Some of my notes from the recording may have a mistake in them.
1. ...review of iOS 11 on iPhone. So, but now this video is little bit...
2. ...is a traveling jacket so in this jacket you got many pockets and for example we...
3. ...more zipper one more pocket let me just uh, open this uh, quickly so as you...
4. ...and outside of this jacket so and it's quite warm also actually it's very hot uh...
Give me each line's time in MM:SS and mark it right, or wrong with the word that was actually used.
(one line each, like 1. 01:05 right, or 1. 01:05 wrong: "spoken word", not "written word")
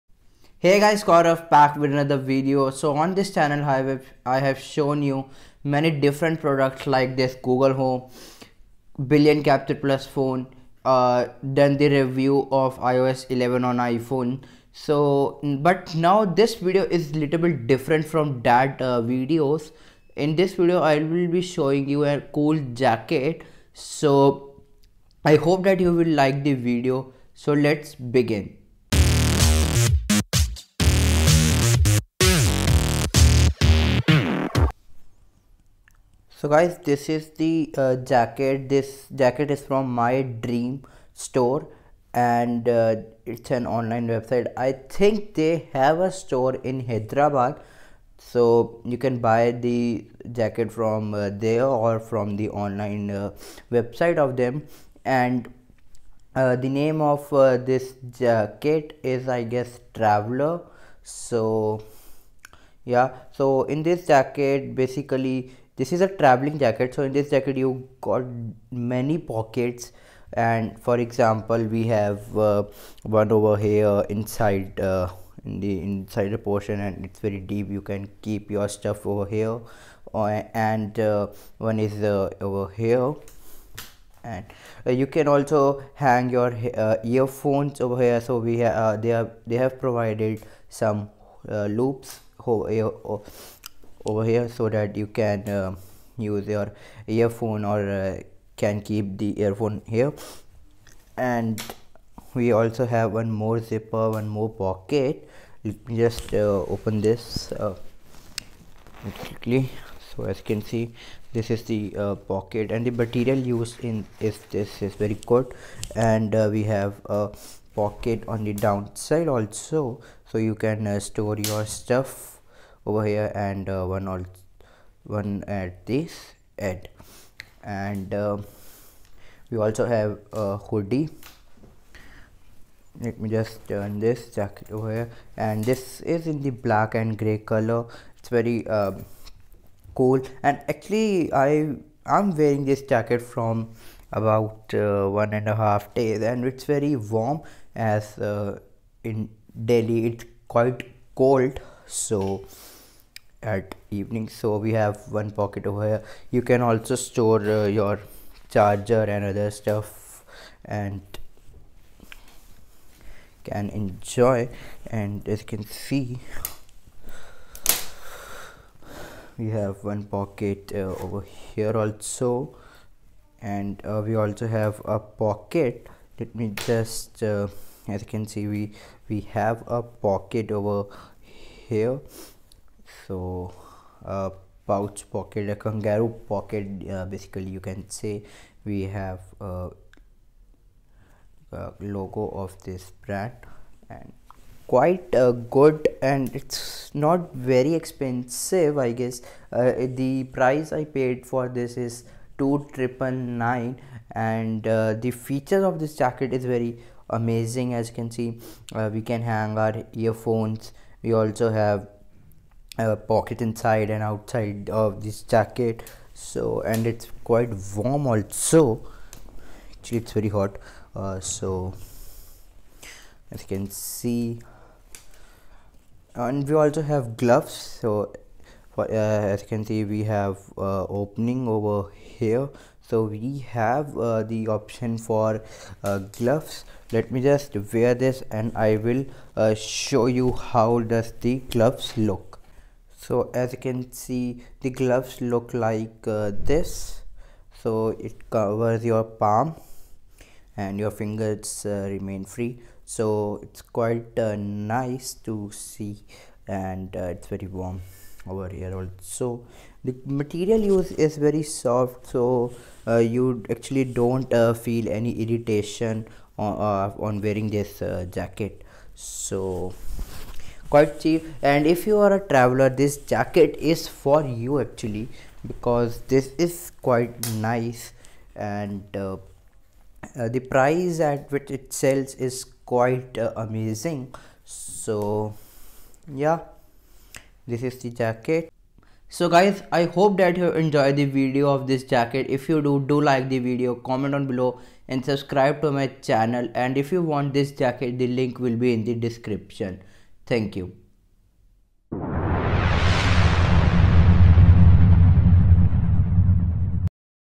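1. 00:11 right
2. 01:05 right
3. 01:43 right
4. 03:33 right.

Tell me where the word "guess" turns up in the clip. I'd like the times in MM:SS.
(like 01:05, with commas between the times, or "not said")
00:59, 03:19.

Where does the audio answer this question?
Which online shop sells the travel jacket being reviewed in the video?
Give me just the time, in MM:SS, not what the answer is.
00:39.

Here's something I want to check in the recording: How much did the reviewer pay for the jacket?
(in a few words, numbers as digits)
2999.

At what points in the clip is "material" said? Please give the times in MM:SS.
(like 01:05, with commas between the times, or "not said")
01:52, 04:20.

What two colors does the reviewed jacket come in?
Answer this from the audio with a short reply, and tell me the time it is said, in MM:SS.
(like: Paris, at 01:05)
Black and gray, at 02:16.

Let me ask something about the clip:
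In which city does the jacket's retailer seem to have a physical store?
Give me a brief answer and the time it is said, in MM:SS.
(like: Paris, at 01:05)
Hyderabad, at 00:46.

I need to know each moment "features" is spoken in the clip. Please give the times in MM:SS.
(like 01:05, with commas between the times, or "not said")
03:25.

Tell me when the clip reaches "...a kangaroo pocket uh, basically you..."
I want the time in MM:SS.
03:05.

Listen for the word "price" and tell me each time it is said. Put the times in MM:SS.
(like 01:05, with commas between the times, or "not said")
03:20, 04:40.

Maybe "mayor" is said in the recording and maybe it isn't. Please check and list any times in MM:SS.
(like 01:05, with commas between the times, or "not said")
not said.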